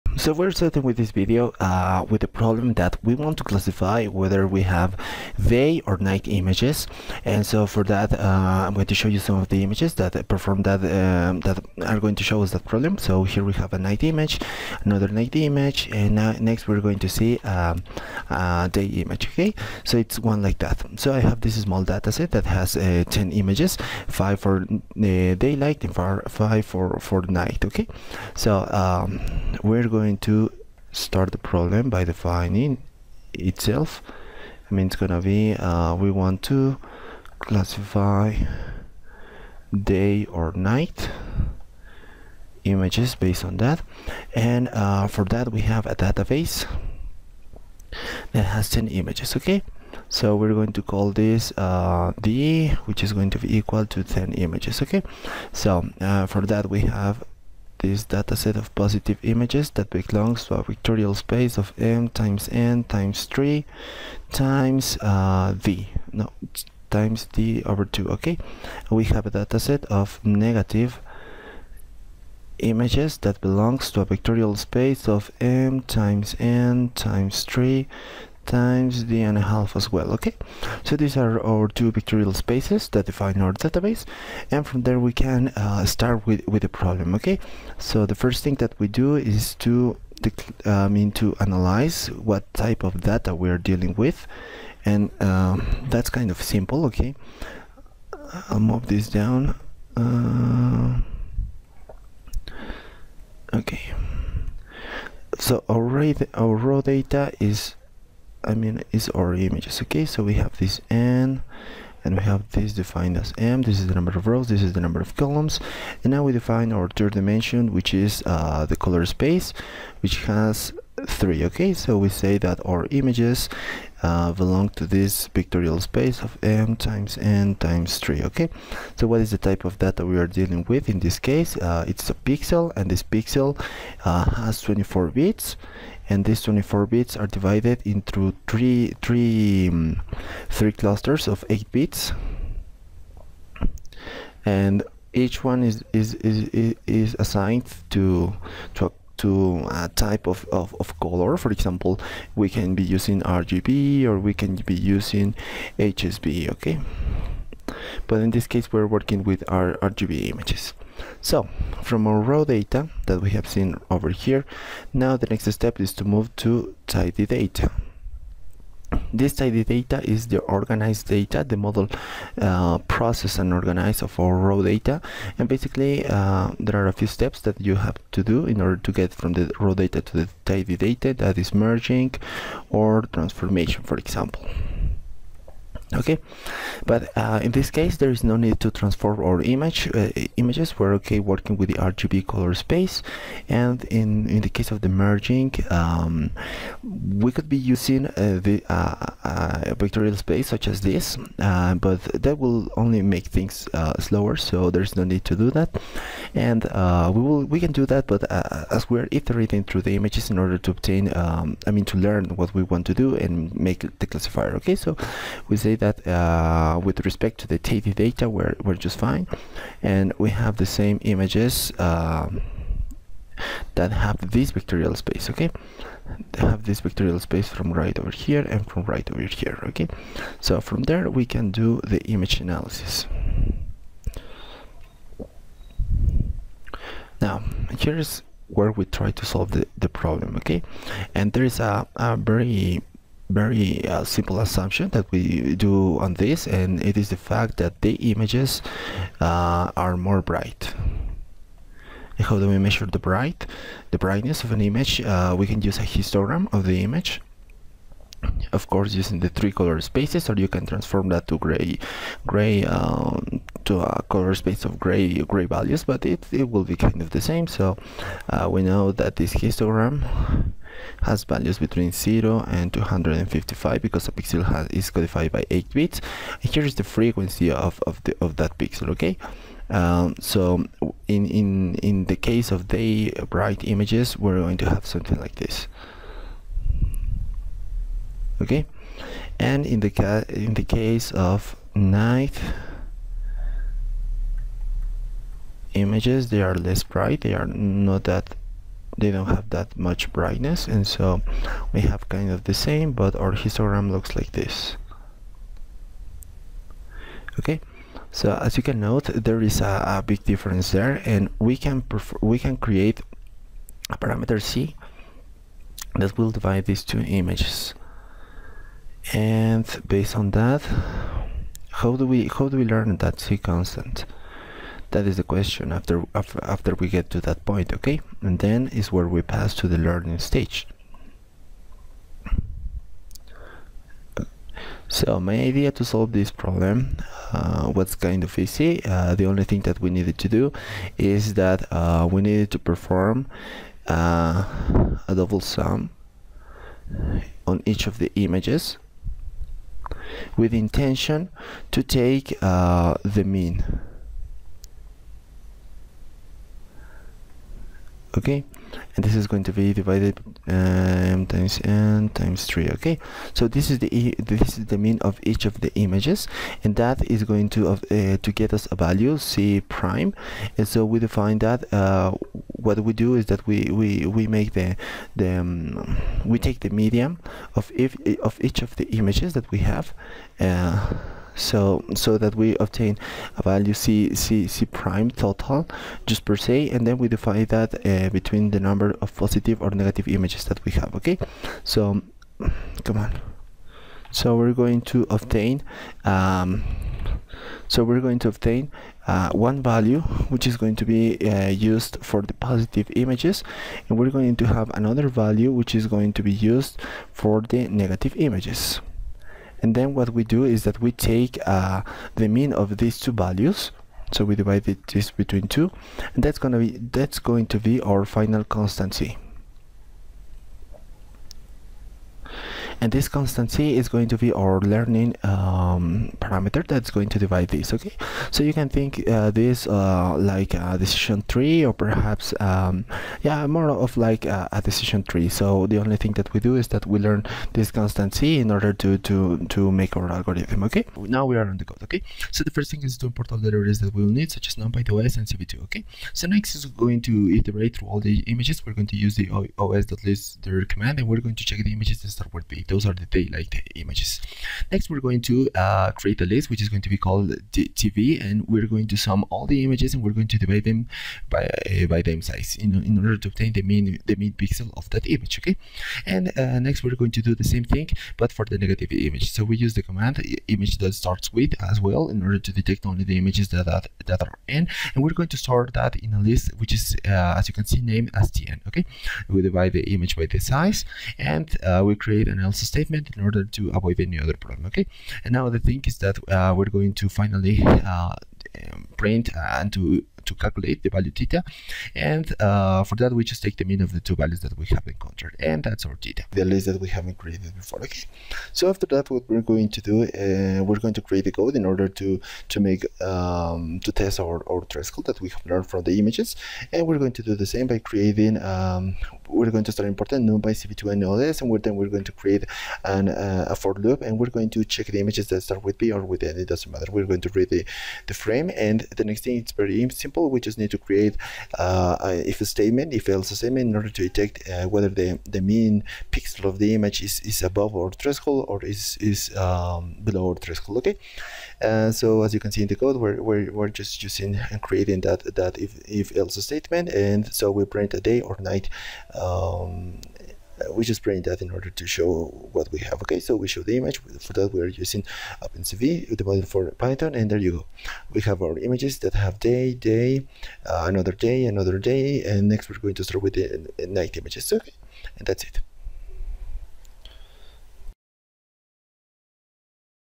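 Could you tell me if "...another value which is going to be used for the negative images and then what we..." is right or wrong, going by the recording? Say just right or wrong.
right.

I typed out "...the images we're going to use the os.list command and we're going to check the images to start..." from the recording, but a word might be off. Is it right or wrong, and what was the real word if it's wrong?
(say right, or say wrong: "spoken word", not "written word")
right.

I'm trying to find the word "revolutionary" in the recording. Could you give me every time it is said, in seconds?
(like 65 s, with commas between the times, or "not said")
not said.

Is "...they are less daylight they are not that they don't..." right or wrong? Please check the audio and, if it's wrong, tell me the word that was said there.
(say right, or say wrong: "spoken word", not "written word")
wrong: "bright", not "daylight".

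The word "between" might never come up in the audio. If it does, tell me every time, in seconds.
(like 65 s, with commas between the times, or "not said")
271 s, 388 s, 415 s.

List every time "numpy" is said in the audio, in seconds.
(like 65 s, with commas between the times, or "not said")
444 s, 510 s.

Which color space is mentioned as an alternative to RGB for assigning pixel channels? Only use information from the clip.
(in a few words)
HSB.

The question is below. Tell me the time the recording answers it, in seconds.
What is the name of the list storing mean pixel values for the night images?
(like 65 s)
478 s.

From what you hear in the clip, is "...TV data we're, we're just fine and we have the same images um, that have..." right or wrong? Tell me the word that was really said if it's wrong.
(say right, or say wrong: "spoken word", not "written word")
right.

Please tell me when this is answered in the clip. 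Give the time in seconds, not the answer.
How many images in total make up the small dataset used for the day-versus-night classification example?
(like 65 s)
23 s.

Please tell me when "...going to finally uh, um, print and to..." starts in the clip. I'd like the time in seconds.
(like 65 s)
486 s.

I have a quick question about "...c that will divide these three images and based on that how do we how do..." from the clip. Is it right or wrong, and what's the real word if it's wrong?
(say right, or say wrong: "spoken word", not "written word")
wrong: "two", not "three".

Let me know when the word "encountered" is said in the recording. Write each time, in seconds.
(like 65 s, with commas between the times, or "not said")
494 s.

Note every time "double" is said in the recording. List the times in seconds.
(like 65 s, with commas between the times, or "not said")
345 s.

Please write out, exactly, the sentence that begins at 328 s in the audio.
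And then is where we pass to the learning stage.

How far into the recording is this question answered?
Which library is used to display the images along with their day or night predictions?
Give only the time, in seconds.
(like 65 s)
545 s.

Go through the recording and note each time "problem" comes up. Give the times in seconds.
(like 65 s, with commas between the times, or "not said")
2 s, 12 s, 31 s, 86 s, 239 s, 336 s, 484 s.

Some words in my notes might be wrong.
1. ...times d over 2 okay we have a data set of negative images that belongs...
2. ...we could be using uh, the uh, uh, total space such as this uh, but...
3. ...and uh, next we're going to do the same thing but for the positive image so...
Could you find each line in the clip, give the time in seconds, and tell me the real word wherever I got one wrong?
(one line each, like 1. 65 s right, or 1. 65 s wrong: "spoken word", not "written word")
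1. 66 s right
2. 196 s wrong: "vectorial", not "total"
3. 466 s wrong: "negative", not "positive".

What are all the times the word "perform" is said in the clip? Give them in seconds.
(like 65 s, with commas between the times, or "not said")
10 s, 342 s.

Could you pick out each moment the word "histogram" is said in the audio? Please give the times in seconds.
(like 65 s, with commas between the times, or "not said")
255 s, 269 s, 303 s.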